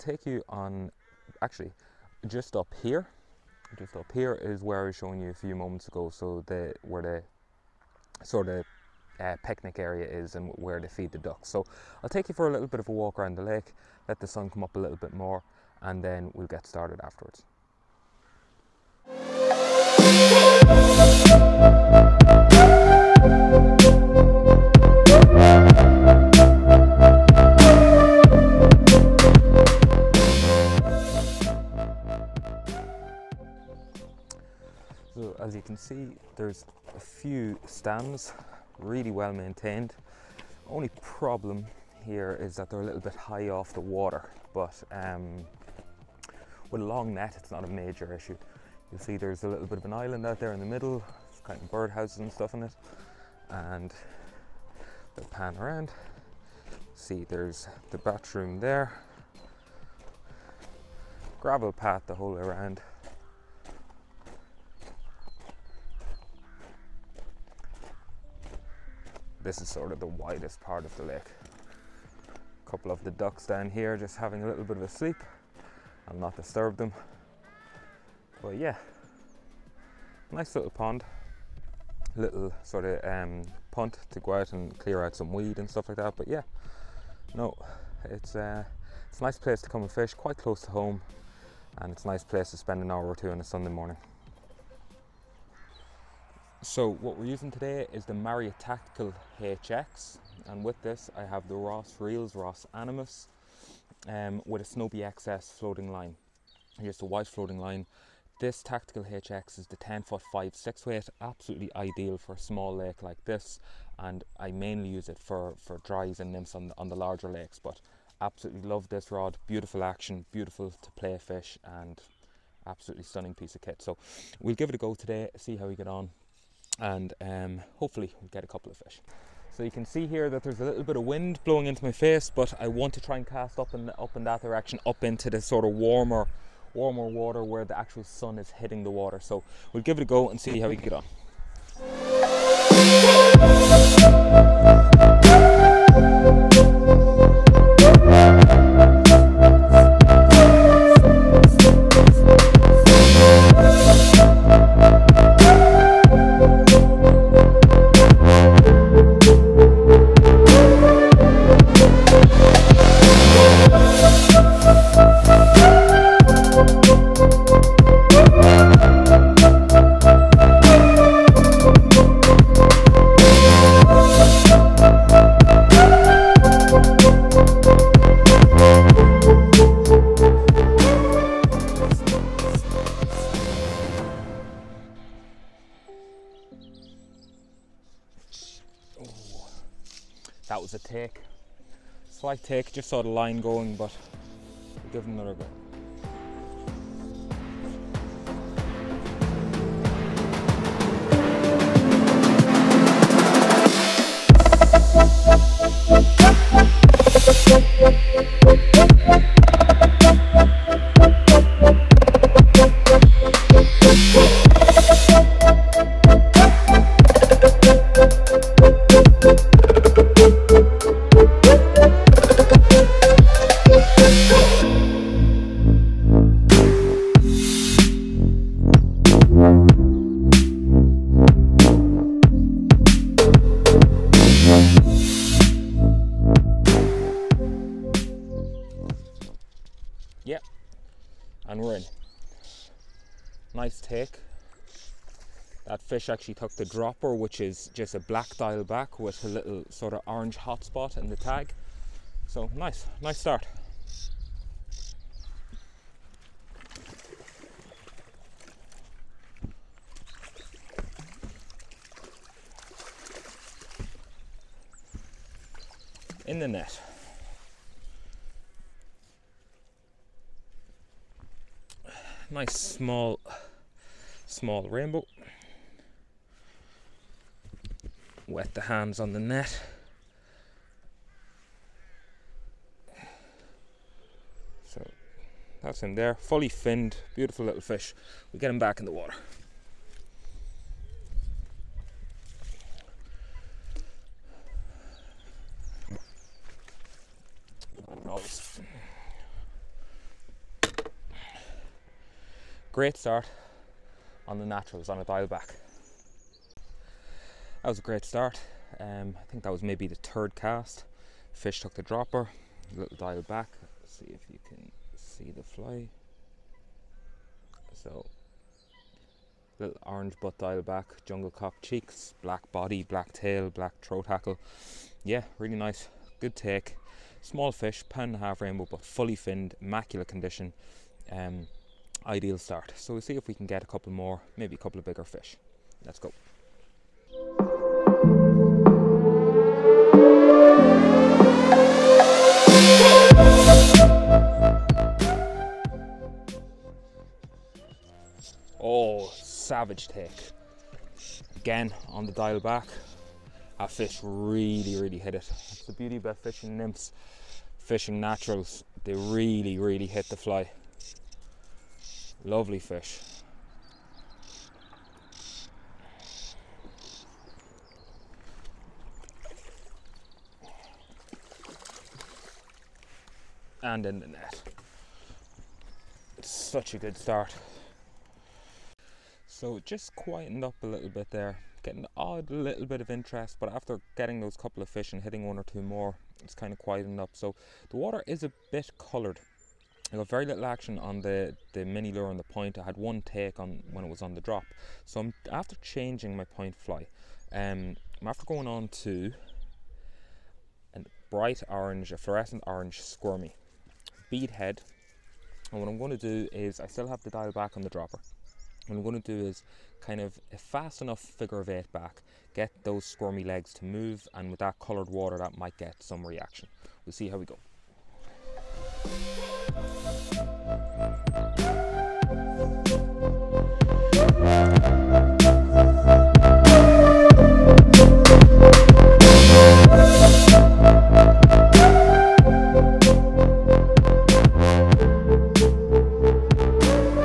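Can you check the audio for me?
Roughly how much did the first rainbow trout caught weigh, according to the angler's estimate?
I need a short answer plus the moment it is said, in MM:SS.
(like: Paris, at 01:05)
1.5 pounds, at 05:27.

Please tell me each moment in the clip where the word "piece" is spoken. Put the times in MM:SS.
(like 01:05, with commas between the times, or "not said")
02:03.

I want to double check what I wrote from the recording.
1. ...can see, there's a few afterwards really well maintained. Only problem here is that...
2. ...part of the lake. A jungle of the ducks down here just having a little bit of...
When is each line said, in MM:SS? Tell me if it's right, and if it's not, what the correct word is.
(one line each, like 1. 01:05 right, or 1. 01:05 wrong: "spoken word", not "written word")
1. 00:35 wrong: "stands", not "afterwards"
2. 01:10 wrong: "couple", not "jungle".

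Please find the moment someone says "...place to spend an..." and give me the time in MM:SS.
01:32.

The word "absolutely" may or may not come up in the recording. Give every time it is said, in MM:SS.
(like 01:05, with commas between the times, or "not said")
01:51, 01:58, 02:02.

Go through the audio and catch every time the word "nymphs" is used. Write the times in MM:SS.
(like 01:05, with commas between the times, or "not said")
01:56, 05:56.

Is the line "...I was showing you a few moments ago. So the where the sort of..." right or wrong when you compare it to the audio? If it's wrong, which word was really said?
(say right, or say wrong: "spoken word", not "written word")
right.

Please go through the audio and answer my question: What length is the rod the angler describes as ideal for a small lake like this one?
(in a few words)
10 foot.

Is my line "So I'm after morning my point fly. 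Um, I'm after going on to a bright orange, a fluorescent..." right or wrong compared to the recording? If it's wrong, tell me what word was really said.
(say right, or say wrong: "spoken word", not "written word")
wrong: "changing", not "morning".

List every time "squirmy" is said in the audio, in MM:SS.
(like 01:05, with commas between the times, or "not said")
06:42, 06:52.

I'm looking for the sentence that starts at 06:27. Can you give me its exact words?
So the water is a bit coloured.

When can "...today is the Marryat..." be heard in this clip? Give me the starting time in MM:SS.
01:37.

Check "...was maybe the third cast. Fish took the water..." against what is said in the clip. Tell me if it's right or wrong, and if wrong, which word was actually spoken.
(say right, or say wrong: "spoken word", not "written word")
wrong: "dropper", not "water".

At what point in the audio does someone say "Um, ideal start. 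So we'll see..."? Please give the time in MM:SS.
05:31.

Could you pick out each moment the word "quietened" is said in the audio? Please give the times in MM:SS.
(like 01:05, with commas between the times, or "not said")
06:19, 06:26.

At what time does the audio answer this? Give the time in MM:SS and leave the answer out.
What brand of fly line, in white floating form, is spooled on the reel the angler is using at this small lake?
01:44.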